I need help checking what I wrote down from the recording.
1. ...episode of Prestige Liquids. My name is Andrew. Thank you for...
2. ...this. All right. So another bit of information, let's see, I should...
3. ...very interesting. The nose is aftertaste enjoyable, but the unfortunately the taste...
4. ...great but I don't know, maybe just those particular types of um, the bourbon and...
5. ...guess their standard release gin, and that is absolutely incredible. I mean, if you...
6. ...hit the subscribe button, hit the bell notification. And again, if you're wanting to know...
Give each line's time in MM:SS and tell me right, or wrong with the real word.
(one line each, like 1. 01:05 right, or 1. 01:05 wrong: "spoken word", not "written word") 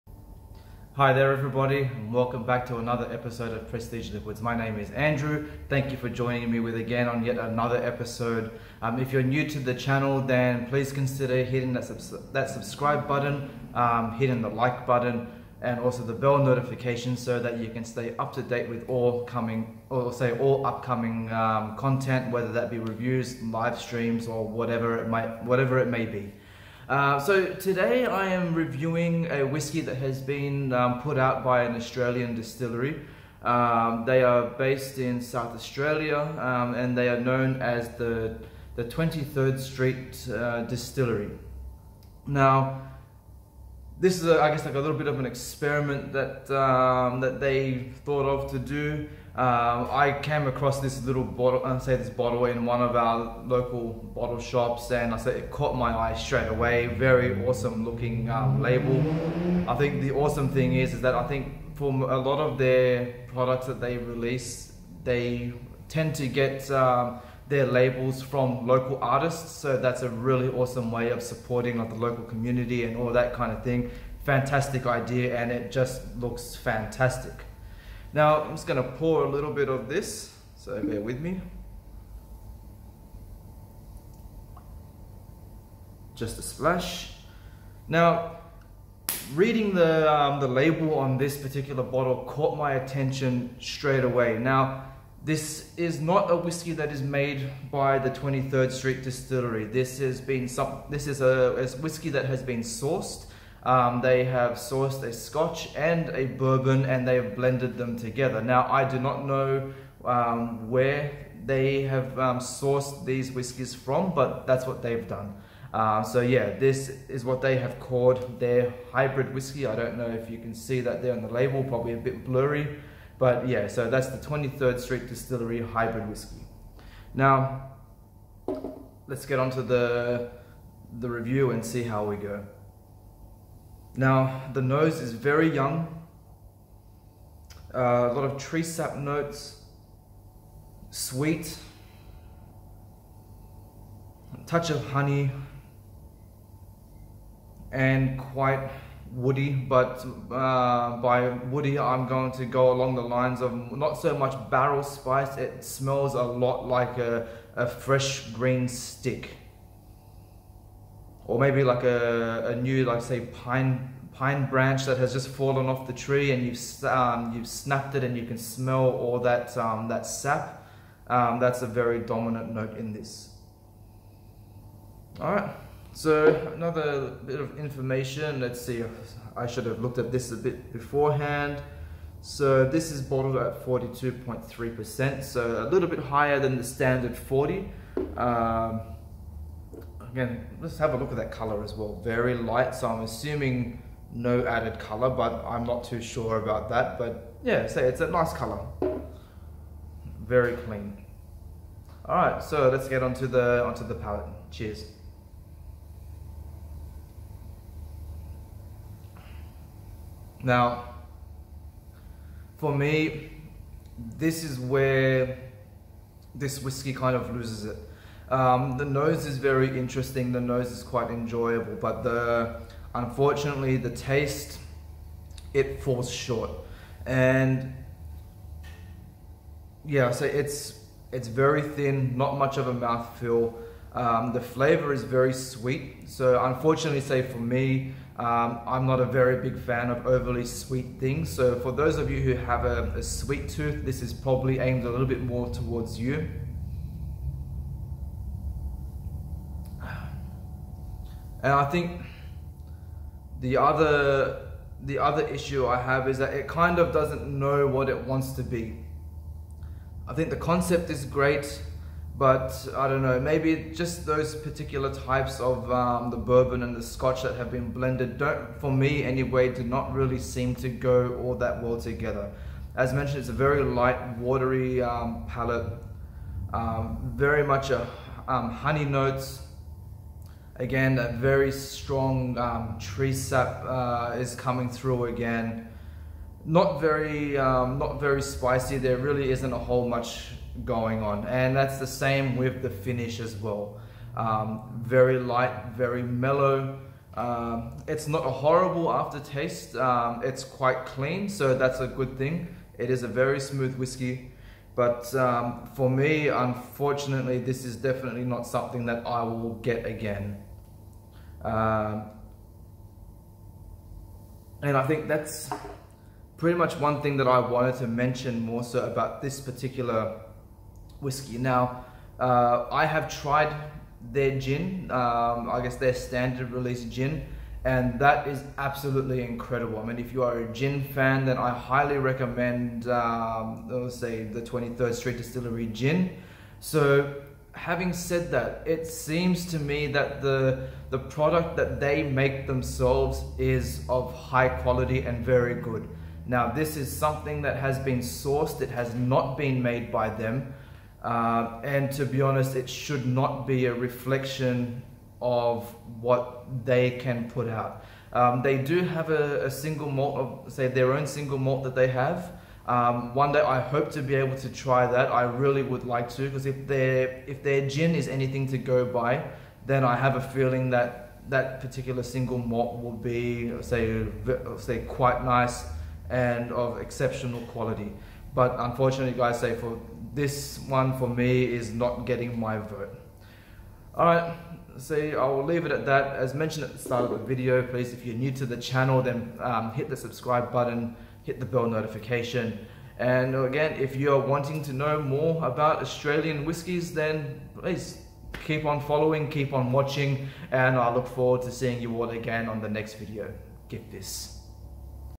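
1. 00:03 right
2. 02:52 right
3. 03:39 wrong: "quite", not "aftertaste"
4. 04:21 right
5. 05:25 right
6. 06:29 right.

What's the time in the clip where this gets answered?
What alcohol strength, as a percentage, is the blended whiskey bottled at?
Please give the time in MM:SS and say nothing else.
03:03.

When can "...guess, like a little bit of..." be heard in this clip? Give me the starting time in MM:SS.
00:44.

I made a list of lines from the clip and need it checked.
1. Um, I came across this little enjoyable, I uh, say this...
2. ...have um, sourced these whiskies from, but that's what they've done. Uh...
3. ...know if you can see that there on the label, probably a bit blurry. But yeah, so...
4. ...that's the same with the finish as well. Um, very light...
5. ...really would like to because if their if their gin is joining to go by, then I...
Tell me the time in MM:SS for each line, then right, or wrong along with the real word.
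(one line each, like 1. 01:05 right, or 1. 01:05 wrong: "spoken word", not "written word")
1. 00:49 wrong: "bottle", not "enjoyable"
2. 01:51 right
3. 01:59 right
4. 04:51 right
5. 06:05 wrong: "anything", not "joining".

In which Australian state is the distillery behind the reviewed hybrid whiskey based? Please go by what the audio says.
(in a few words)
South Australia.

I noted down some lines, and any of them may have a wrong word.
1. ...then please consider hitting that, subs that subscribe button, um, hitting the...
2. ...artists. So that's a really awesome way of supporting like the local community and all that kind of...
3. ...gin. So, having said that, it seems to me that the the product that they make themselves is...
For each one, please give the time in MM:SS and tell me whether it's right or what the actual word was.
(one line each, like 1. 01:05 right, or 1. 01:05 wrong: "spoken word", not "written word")
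1. 00:10 right
2. 01:09 right
3. 05:35 right.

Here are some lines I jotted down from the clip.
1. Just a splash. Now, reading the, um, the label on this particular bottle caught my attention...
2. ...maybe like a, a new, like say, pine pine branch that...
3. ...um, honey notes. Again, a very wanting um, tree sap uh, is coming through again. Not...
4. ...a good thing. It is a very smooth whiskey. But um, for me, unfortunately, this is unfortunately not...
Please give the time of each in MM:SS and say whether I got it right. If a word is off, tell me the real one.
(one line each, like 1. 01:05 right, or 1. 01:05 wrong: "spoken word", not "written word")
1. 01:26 right
2. 02:41 right
3. 04:38 wrong: "strong", not "wanting"
4. 05:01 wrong: "definitely", not "unfortunately".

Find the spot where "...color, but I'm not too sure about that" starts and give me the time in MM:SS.
03:14.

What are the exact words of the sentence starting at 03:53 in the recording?
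Um, the flavor is very sweet.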